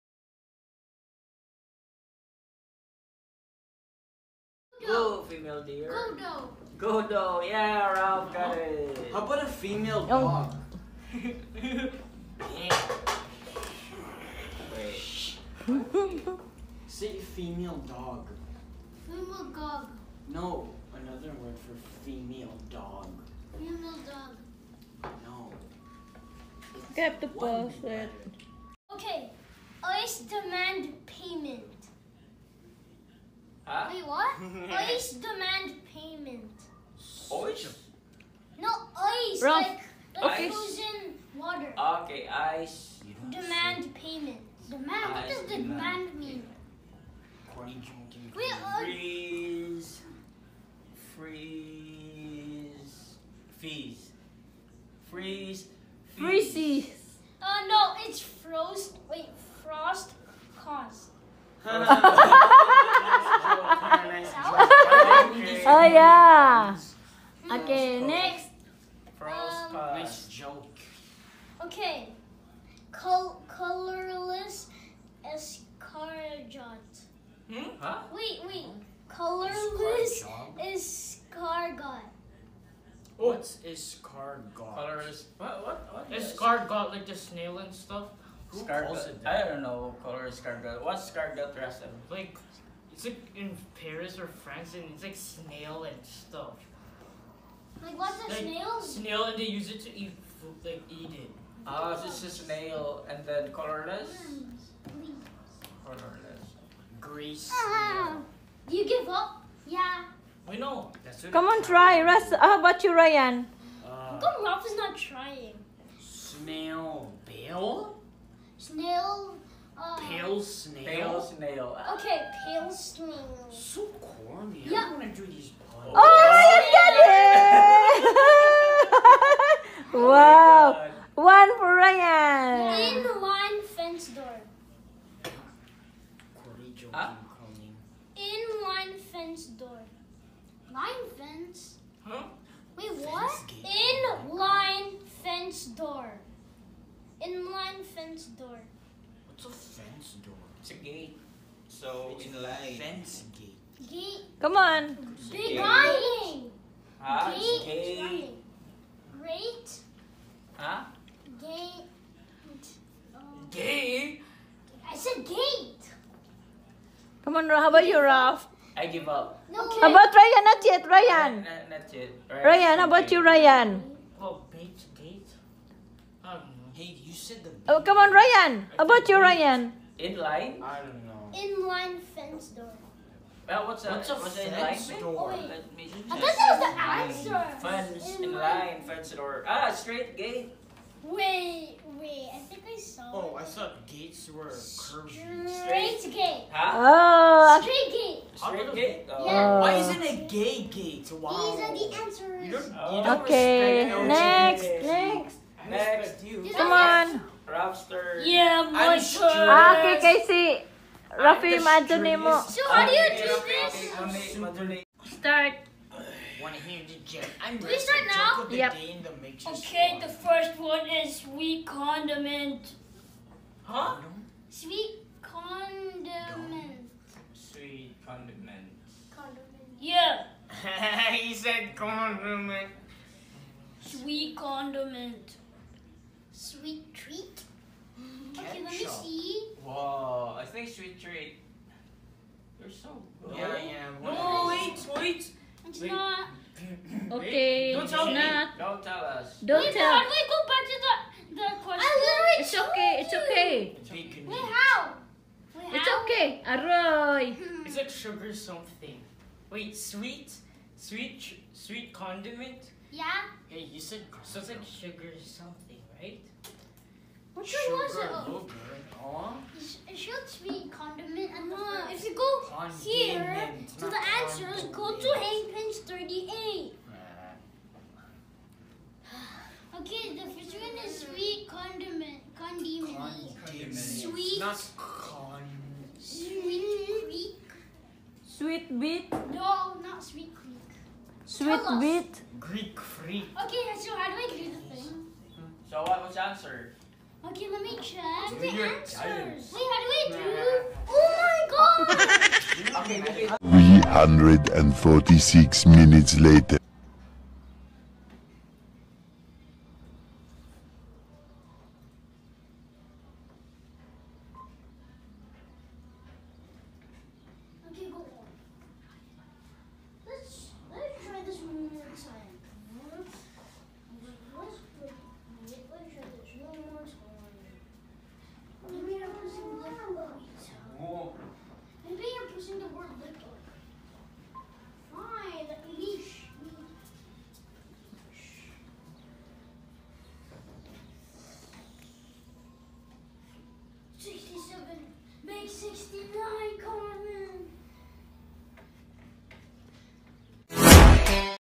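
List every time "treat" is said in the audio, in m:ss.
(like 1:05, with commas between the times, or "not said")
3:56, 4:00.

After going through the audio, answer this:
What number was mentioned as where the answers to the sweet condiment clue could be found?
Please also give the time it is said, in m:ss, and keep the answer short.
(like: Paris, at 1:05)
38, at 4:35.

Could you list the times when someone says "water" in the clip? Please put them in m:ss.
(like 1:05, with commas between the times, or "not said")
0:41.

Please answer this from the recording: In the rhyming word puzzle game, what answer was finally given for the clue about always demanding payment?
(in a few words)
frost cost.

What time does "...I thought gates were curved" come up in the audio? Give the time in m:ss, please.
3:13.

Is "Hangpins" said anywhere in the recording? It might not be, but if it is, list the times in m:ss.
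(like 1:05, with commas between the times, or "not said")
4:35.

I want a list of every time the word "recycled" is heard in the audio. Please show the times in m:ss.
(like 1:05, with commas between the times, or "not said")
not said.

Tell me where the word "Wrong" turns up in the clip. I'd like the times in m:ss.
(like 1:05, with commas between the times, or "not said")
0:39.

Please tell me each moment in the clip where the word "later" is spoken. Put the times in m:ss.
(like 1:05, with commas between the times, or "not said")
5:06.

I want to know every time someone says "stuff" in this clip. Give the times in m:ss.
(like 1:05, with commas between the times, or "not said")
1:27, 1:36.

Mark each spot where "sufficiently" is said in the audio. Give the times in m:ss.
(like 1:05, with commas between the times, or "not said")
not said.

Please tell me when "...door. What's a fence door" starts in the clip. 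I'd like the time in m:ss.
2:28.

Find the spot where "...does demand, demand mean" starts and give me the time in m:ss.
0:45.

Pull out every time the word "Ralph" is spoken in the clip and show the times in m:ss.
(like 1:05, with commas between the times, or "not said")
0:07, 1:54, 2:48.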